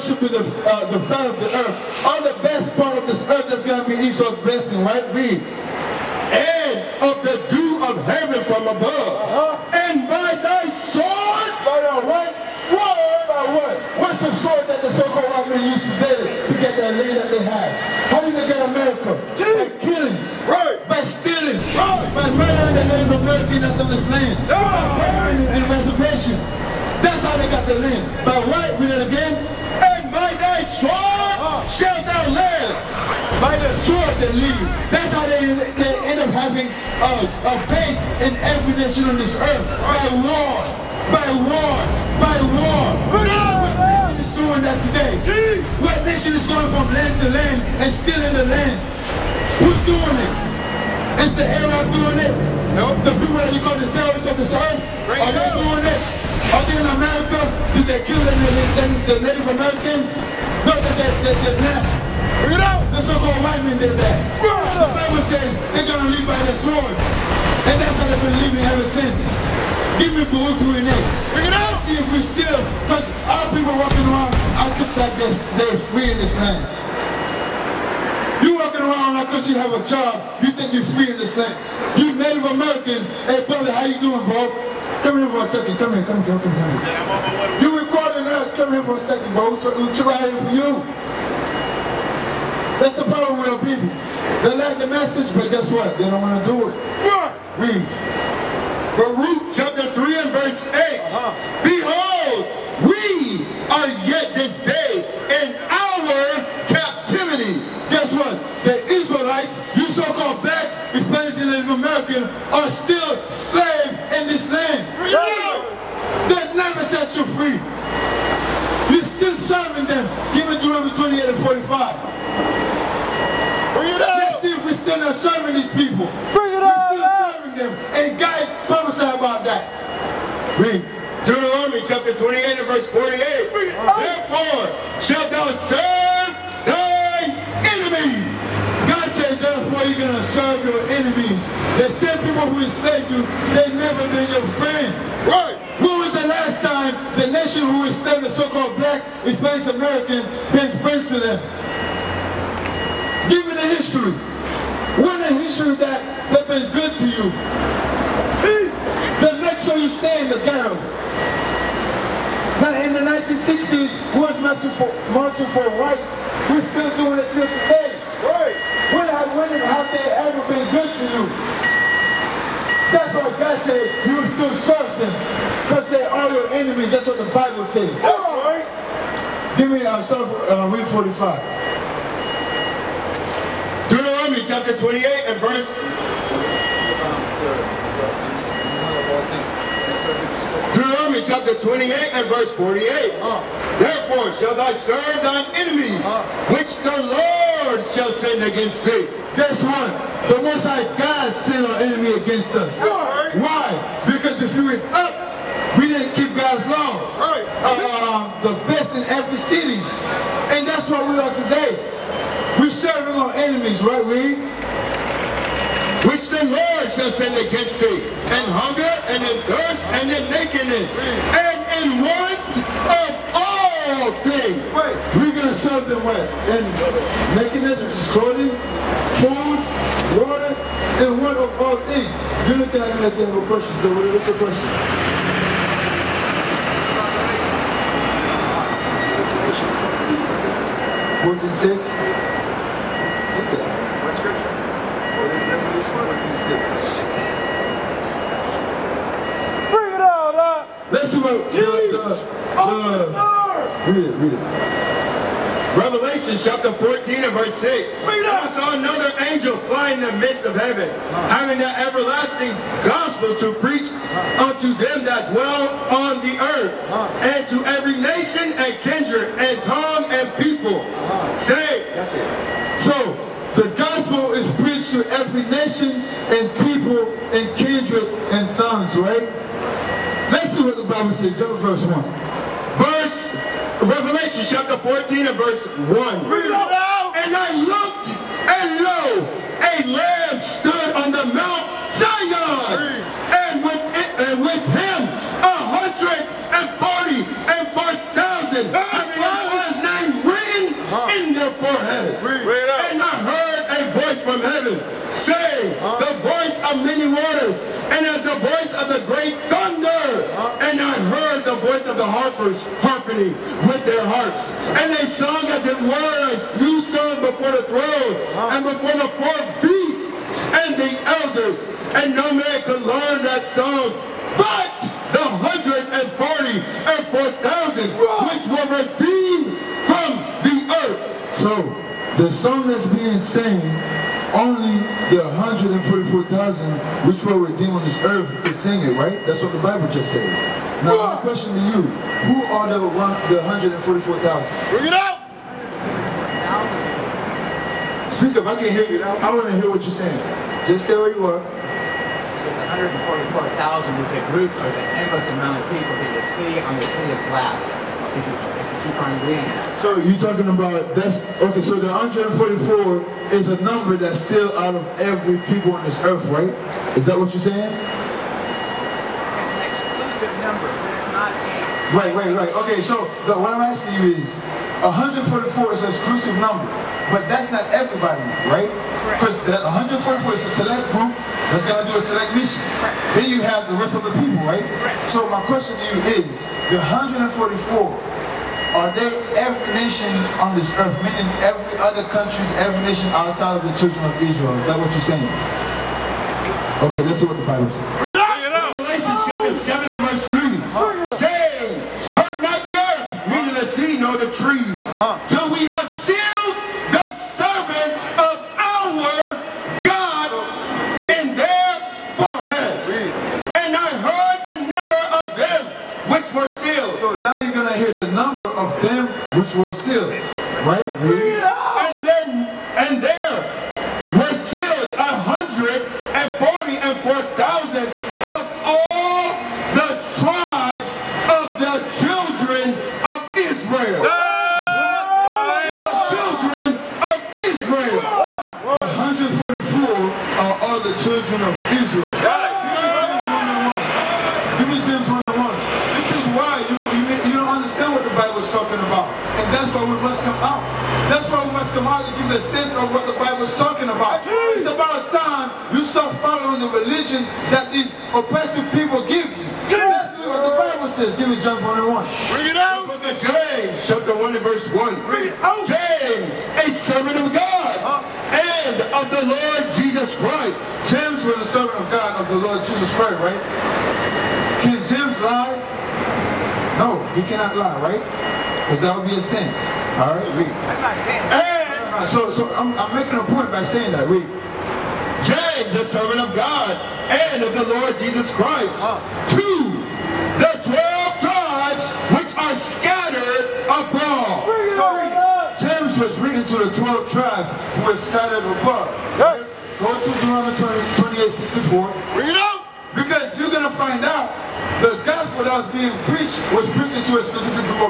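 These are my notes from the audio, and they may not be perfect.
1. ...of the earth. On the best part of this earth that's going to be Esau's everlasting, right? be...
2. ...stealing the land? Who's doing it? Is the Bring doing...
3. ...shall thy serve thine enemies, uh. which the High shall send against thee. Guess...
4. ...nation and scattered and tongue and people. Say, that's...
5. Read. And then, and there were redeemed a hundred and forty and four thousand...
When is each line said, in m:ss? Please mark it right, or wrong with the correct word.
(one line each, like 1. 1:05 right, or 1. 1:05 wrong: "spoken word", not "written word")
1. 0:01 wrong: "blessing", not "everlasting"
2. 0:47 wrong: "Arab", not "Bring"
3. 3:14 wrong: "Lord", not "High"
4. 4:27 wrong: "kindred", not "scattered"
5. 7:01 wrong: "sealed", not "redeemed".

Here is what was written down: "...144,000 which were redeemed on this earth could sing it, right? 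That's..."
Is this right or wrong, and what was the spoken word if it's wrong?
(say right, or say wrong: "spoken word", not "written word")
right.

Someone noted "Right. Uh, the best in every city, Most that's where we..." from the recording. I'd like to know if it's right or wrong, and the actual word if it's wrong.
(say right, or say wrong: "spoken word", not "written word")
wrong: "And", not "Most".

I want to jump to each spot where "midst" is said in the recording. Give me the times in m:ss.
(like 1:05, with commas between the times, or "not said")
4:20.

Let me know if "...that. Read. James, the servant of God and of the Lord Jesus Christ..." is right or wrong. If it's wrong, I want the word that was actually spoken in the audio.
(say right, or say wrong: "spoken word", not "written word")
right.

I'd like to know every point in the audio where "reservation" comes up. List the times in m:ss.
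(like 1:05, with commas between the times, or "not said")
0:25.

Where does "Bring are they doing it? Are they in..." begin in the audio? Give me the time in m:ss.
0:55.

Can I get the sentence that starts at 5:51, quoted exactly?
So the 144,000 with the group are the endless amount of people that you see on the sea of glass.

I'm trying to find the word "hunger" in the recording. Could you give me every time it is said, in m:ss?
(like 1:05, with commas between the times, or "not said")
3:38.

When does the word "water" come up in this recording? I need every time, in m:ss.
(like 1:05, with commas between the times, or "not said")
3:50, 5:07.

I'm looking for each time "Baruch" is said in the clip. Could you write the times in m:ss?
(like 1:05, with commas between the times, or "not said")
1:10, 1:38.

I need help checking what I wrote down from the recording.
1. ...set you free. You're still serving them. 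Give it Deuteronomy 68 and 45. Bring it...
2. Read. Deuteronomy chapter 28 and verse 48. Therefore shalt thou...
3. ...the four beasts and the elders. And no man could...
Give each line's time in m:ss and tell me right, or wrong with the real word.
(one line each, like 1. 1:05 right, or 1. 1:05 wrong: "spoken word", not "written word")
1. 1:56 wrong: "28", not "68"
2. 2:10 right
3. 5:18 right.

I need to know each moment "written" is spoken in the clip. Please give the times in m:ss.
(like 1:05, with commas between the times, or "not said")
5:00, 8:16.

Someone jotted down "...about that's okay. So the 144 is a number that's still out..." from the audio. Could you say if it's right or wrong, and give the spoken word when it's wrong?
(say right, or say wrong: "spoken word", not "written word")
right.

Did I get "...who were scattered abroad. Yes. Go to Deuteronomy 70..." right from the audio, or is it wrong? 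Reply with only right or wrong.
wrong.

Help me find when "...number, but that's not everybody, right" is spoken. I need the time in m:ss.
6:16.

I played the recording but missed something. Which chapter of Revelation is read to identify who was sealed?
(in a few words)
Chapter 7.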